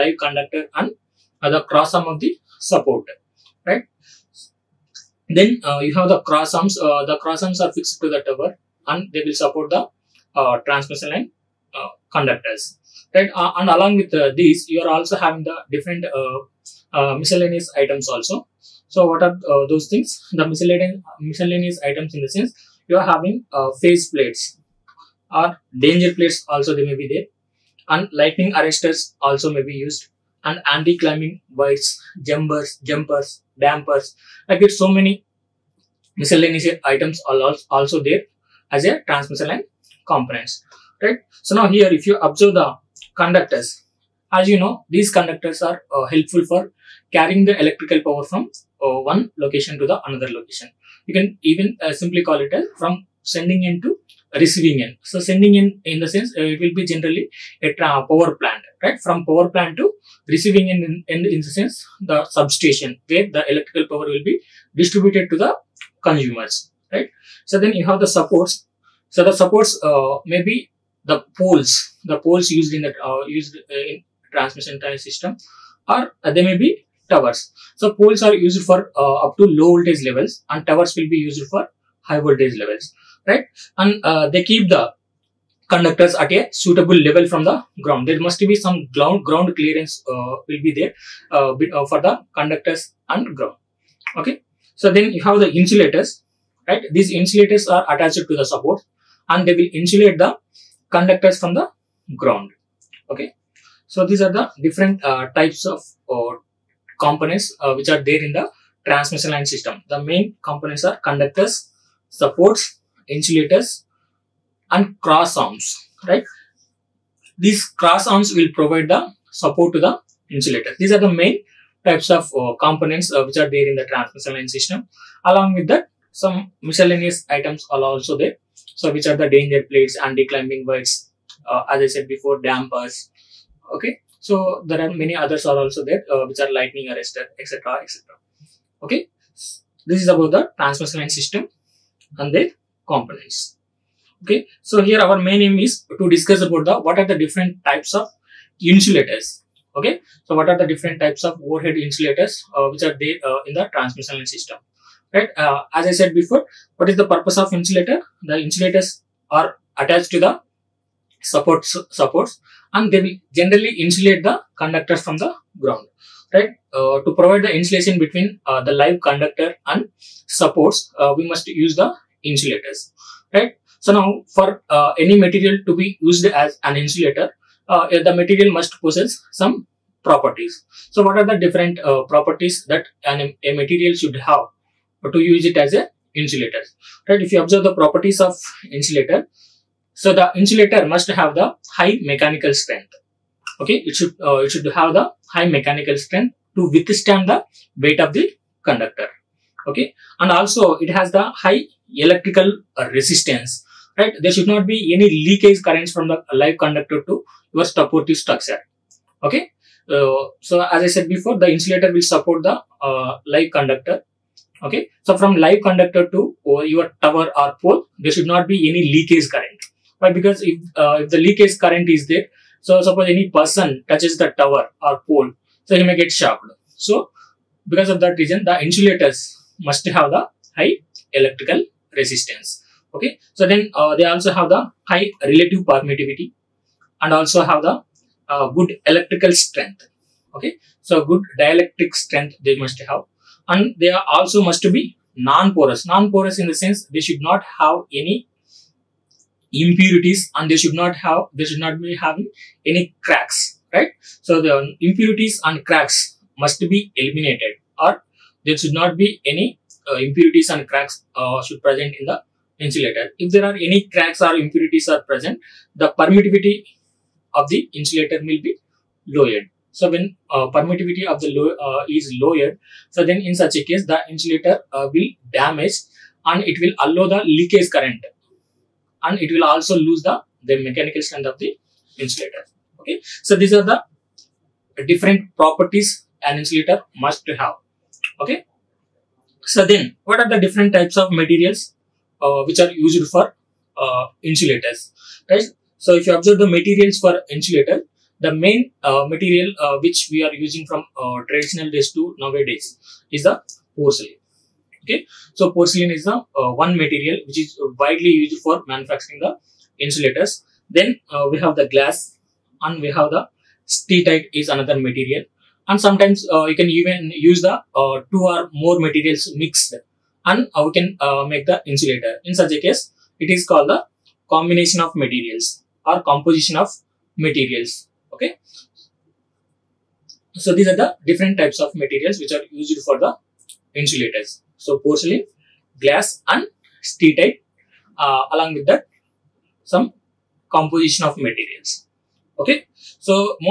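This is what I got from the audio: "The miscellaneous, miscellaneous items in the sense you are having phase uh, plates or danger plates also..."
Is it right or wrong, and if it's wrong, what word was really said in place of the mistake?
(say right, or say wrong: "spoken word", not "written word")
right.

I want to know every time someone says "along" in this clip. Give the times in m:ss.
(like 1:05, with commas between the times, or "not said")
0:13, 2:05, 5:38.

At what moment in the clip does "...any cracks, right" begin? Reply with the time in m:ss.
4:12.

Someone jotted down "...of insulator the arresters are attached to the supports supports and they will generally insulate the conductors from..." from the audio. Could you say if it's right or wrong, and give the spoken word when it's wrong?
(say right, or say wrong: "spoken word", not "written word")
wrong: "insulators", not "arresters".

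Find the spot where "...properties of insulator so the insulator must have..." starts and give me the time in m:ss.
3:07.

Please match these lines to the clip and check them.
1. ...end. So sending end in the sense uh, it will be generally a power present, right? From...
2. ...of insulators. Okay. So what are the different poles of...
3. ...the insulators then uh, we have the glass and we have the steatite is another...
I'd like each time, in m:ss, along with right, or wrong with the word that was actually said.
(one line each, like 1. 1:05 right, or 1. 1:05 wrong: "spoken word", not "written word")
1. 0:54 wrong: "plant", not "present"
2. 2:27 wrong: "types", not "poles"
3. 5:09 right.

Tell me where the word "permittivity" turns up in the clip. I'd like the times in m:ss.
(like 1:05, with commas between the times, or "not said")
3:55, 4:25, 4:30.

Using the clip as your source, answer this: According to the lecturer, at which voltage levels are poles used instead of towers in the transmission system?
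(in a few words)
Low voltage levels.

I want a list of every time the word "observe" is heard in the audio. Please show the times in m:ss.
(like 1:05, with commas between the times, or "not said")
0:42, 3:07, 4:56.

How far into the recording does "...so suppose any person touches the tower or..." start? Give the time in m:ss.
3:42.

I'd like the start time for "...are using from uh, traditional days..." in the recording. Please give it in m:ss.
5:00.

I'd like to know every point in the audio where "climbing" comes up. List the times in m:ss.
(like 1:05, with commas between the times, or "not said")
0:30, 2:10.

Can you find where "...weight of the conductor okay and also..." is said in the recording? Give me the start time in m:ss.
3:17.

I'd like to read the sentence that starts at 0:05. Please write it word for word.
Then uh, you have the cross arms.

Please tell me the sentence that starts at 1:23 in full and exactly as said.
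And uh, they keep the conductors at a suitable level from the ground.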